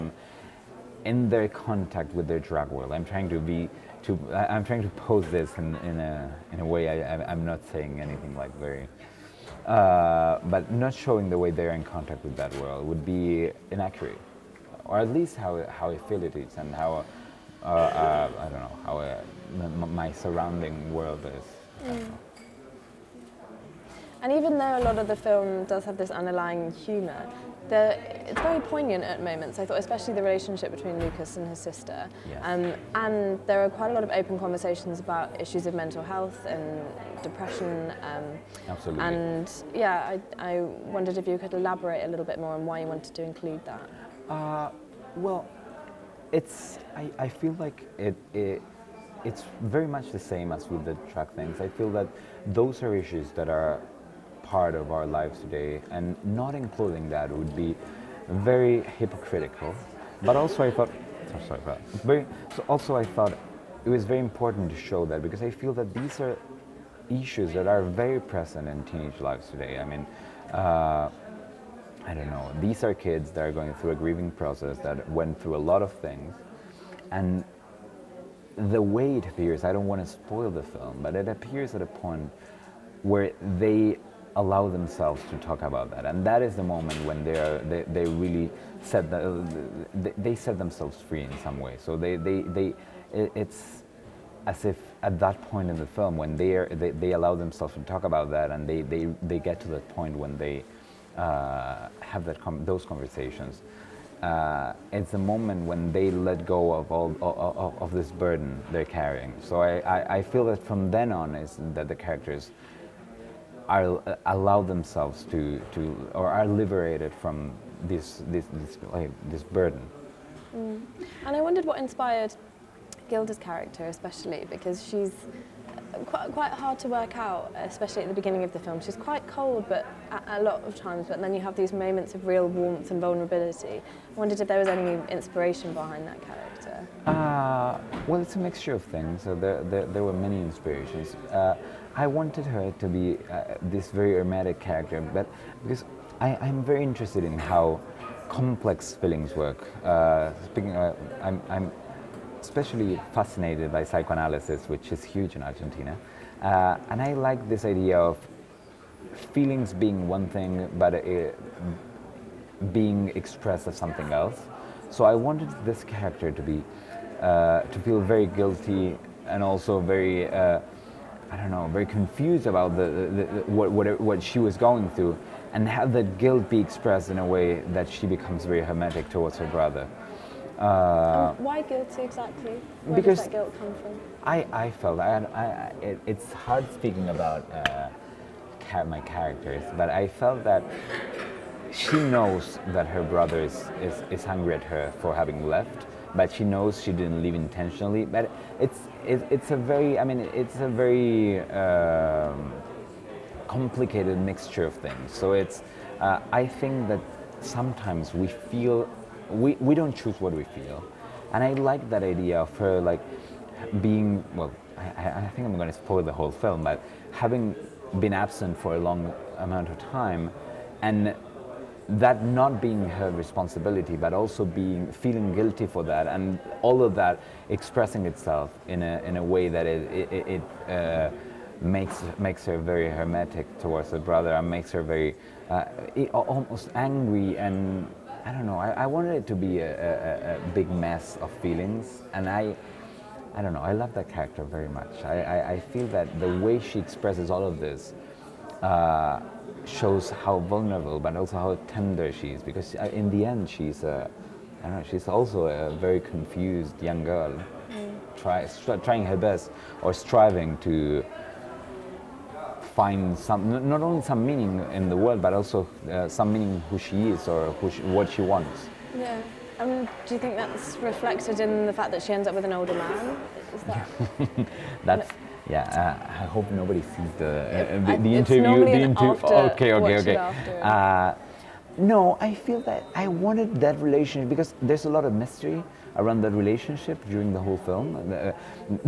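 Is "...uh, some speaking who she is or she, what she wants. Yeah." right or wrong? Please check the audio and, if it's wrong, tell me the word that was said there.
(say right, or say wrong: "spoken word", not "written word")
wrong: "meaning", not "speaking".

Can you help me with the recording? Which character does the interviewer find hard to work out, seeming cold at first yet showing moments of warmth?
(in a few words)
Gilda.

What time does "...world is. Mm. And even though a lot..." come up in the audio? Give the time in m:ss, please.
0:20.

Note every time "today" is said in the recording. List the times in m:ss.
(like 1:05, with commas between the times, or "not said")
0:55, 1:09.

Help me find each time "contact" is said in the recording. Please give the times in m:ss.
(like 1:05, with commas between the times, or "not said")
0:01, 0:11.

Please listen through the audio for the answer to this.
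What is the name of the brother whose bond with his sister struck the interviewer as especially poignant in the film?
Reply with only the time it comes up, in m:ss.
0:30.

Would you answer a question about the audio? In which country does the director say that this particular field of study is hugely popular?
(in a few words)
Argentina.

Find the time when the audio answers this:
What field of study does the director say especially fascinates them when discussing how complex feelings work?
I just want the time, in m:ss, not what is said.
2:33.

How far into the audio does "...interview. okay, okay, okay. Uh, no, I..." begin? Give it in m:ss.
4:38.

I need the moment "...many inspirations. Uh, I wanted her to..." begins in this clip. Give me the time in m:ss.
2:20.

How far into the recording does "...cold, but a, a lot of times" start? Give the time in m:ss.
2:09.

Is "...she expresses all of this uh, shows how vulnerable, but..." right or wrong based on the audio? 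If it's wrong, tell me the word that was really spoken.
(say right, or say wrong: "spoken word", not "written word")
right.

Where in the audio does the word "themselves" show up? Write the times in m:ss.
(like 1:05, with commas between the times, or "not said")
1:24, 1:30, 1:37, 1:54.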